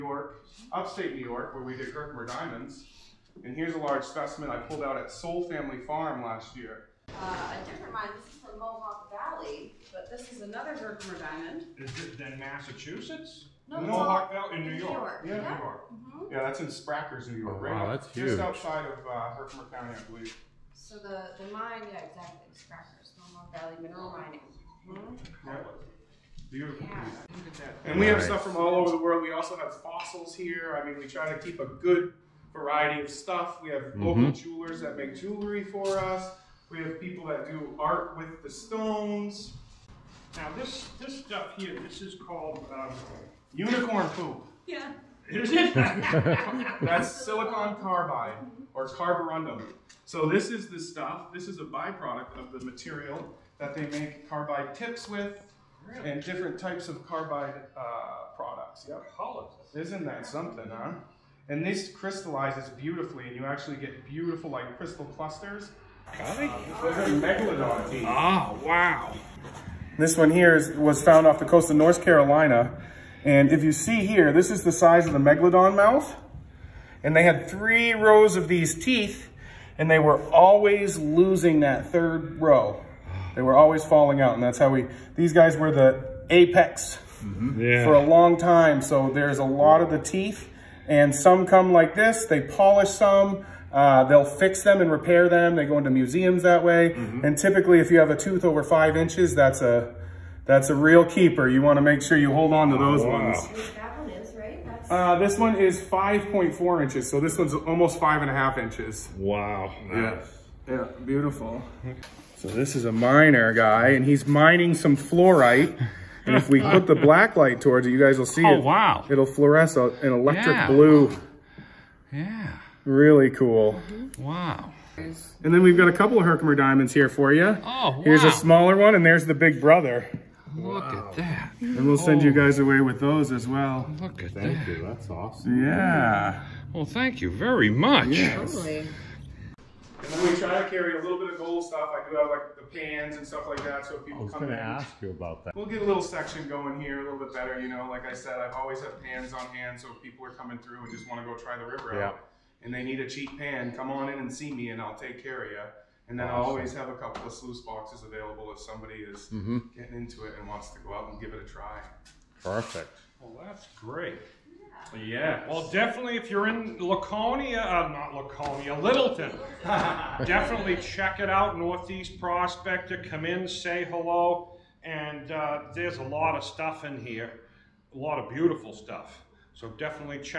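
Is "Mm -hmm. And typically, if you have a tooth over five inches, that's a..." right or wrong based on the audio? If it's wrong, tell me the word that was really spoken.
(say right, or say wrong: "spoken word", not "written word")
right.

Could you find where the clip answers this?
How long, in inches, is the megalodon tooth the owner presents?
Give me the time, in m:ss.
1:45.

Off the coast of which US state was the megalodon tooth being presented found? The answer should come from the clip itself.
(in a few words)
North Carolina.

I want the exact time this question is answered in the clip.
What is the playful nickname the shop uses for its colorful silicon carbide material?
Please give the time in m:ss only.
0:43.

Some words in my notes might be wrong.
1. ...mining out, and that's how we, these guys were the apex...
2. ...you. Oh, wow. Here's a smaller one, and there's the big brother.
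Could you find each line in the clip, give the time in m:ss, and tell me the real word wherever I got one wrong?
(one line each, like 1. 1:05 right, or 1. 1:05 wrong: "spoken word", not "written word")
1. 1:23 wrong: "falling", not "mining"
2. 2:07 right.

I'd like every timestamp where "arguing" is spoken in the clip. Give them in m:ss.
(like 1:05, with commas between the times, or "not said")
not said.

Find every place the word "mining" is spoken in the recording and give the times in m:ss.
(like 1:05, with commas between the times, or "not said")
0:24, 1:54.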